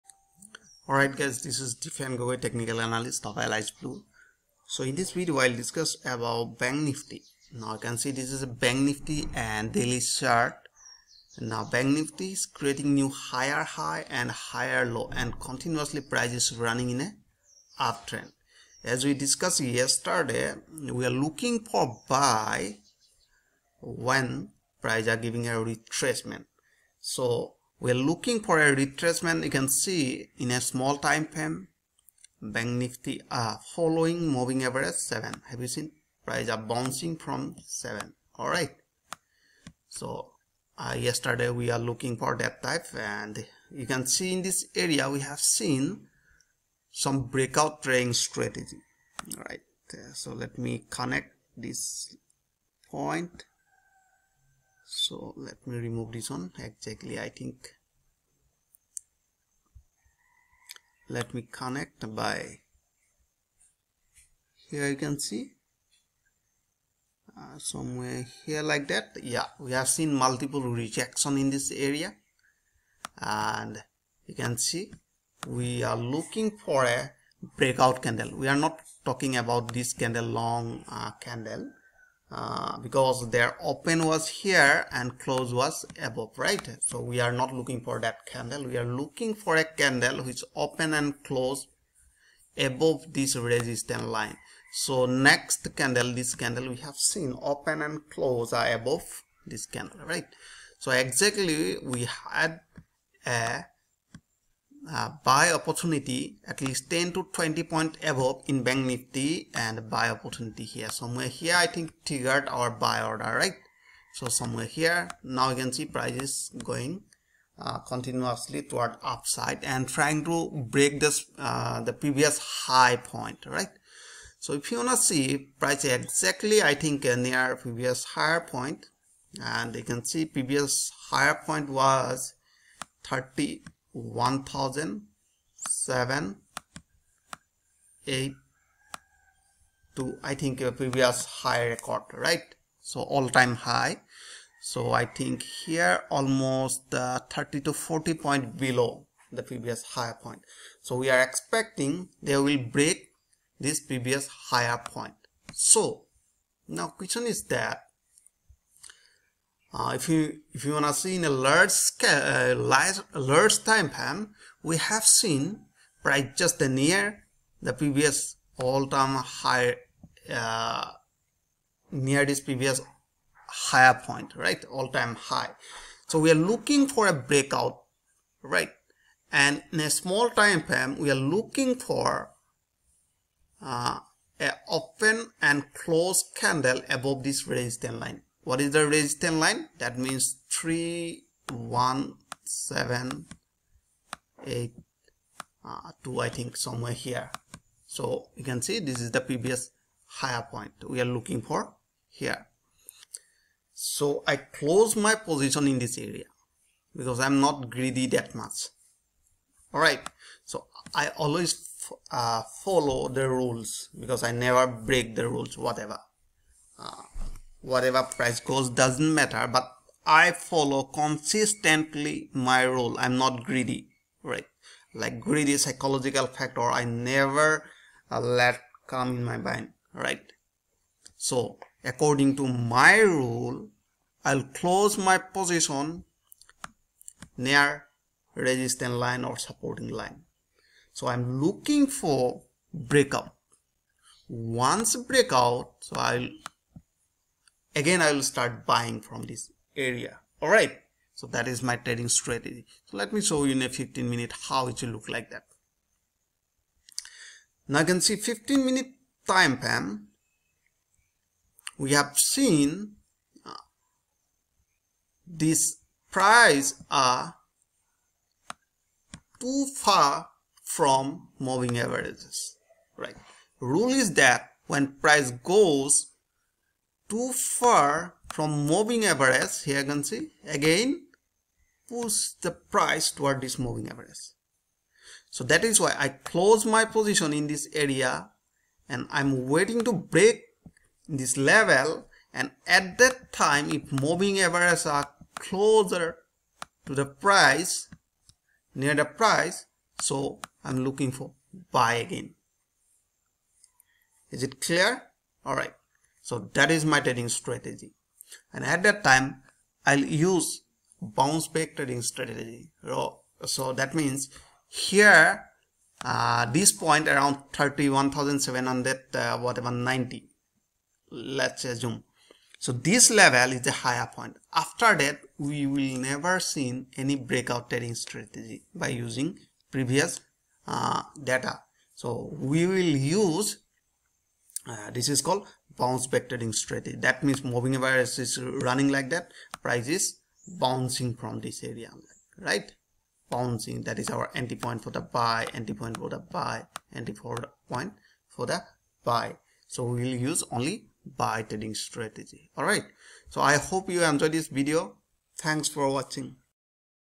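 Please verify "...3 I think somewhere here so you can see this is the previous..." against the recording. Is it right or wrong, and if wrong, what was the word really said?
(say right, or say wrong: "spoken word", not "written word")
wrong: "2", not "3".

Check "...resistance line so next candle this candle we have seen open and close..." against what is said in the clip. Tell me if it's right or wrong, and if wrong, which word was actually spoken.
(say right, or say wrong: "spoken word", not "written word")
right.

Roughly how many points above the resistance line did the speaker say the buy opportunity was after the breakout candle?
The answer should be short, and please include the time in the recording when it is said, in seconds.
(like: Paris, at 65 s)
10 to 20, at 106 s.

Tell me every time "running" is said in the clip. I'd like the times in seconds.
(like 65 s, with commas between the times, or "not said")
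16 s, 338 s.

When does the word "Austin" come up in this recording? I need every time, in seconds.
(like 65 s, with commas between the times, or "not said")
not said.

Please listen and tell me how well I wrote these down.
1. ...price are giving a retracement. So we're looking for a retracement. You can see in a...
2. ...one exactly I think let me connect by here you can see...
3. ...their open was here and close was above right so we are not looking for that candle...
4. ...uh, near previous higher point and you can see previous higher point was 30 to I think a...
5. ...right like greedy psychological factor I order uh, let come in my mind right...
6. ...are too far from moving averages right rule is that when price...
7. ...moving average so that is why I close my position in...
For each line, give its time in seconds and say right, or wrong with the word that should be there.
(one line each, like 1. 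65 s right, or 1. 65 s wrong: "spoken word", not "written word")
1. 24 s right
2. 56 s right
3. 83 s right
4. 127 s right
5. 224 s wrong: "never", not "order"
6. 266 s right
7. 283 s right.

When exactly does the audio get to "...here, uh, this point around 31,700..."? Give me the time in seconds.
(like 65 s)
314 s.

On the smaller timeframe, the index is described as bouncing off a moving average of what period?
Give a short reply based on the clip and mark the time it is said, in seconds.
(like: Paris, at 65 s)
7, at 34 s.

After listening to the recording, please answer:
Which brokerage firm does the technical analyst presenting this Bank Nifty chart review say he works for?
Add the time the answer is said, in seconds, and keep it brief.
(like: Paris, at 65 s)
Alice Blue, at 3 s.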